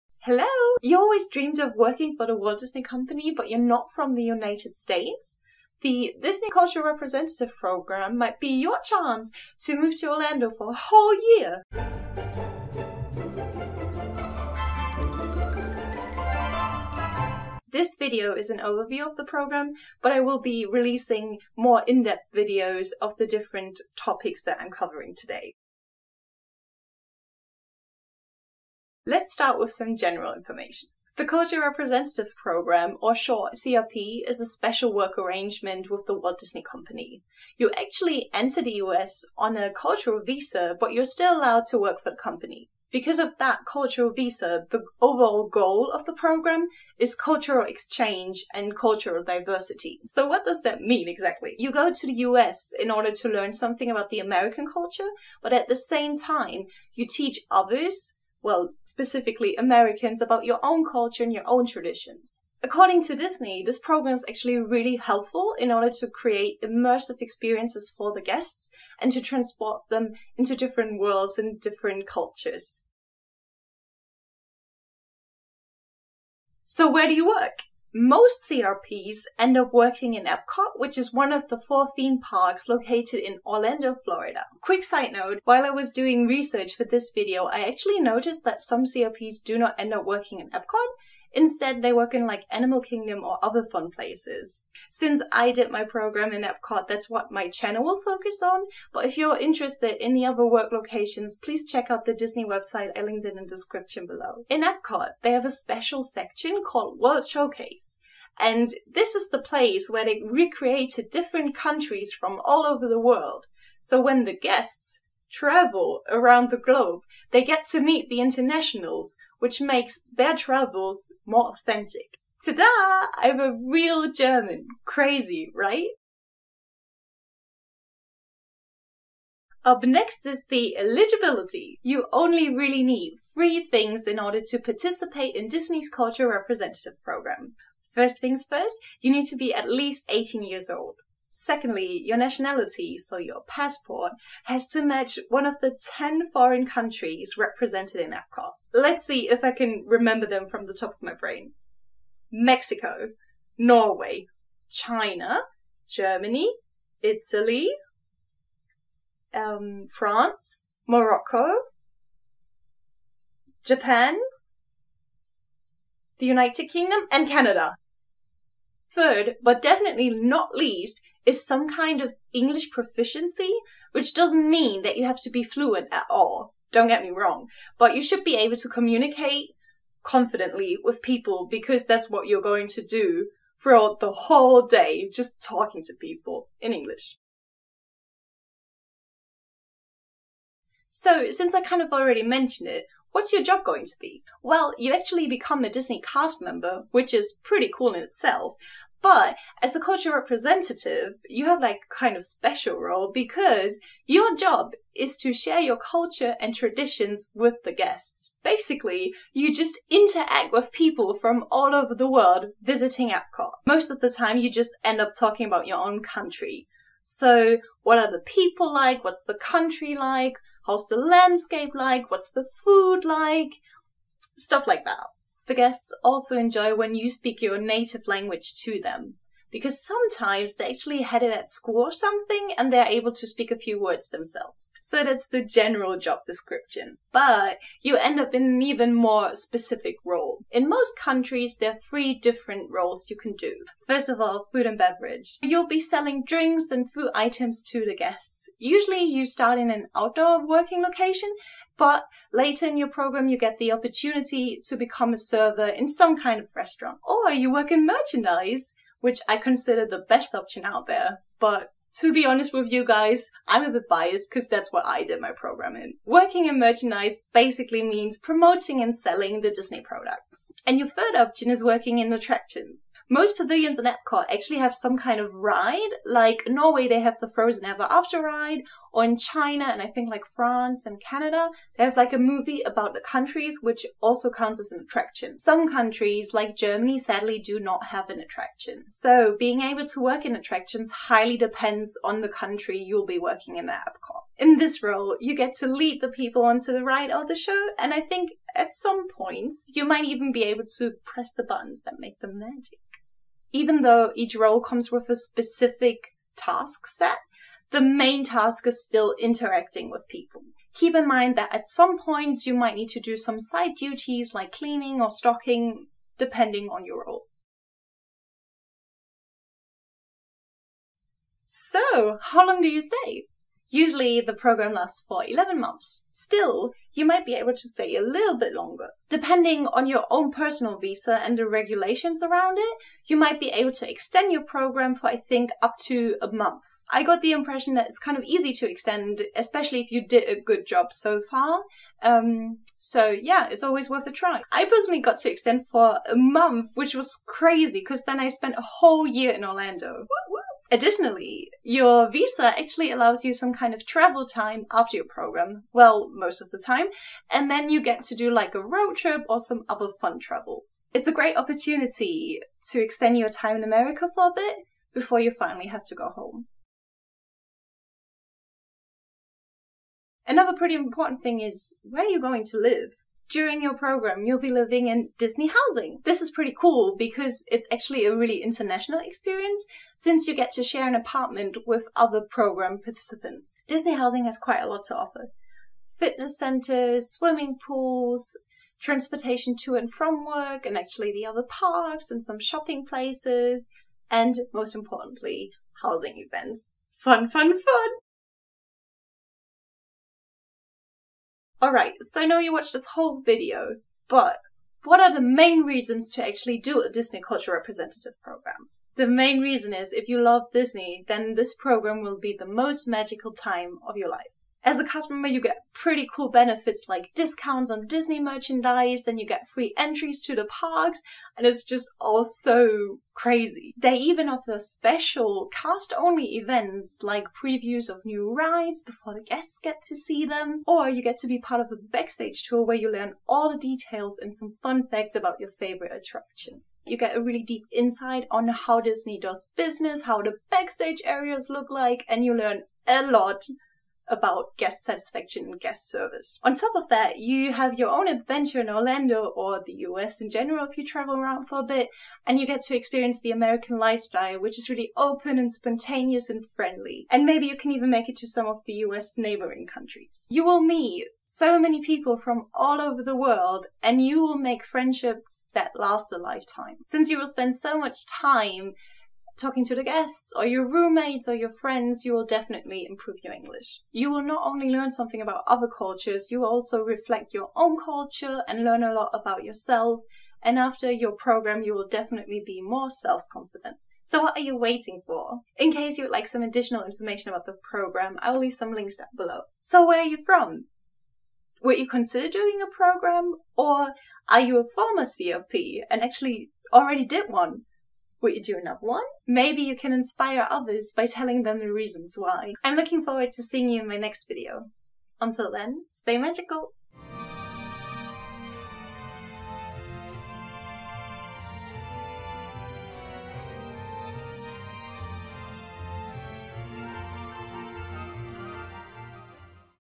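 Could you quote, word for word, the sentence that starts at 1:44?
In Epcot, they have a special section called World Showcase.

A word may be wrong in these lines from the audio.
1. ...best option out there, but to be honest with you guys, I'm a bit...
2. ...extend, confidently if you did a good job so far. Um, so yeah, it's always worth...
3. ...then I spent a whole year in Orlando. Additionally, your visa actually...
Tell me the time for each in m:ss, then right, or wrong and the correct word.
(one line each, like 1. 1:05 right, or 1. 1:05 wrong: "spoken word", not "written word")
1. 4:20 right
2. 5:38 wrong: "especially", not "confidently"
3. 5:48 right.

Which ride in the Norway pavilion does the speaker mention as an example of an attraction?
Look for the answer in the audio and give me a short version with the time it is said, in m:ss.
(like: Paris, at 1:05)
Frozen Ever After, at 4:37.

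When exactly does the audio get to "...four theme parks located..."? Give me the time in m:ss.
1:21.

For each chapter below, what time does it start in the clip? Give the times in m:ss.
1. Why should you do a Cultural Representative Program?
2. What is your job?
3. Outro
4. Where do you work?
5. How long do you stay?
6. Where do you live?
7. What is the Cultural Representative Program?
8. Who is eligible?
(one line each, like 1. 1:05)
1. 6:38
2. 3:08
3. 8:10
4. 1:13
5. 5:18
6. 6:07
7. 0:26
8. 2:06.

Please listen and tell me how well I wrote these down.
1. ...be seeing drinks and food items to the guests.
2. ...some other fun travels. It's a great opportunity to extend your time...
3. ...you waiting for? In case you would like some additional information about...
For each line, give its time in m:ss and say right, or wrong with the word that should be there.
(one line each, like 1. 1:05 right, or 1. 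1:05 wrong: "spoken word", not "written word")
1. 4:05 wrong: "selling", not "seeing"
2. 5:59 right
3. 8:04 right.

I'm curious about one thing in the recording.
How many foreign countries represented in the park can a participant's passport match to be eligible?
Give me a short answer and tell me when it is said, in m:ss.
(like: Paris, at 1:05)
10, at 2:25.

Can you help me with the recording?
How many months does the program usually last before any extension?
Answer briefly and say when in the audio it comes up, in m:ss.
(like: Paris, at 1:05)
11, at 5:25.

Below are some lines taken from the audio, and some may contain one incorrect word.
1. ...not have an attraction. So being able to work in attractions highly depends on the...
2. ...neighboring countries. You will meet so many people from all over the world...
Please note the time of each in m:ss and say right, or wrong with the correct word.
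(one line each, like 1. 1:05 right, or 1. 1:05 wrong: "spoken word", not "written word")
1. 4:47 right
2. 7:39 right.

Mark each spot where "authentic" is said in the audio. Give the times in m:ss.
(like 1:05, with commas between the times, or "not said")
2:01.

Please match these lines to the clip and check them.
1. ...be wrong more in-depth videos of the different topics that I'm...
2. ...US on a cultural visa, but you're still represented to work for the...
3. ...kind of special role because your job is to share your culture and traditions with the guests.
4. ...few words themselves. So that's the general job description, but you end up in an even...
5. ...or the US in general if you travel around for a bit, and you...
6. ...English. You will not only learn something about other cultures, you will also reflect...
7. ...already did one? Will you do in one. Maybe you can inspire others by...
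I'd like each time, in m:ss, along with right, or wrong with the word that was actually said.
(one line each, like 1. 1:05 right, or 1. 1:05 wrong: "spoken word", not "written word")
1. 0:20 wrong: "releasing", not "wrong"
2. 0:38 wrong: "allowed", not "represented"
3. 3:21 right
4. 3:53 right
5. 7:29 right
6. 7:53 right
7. 8:16 right.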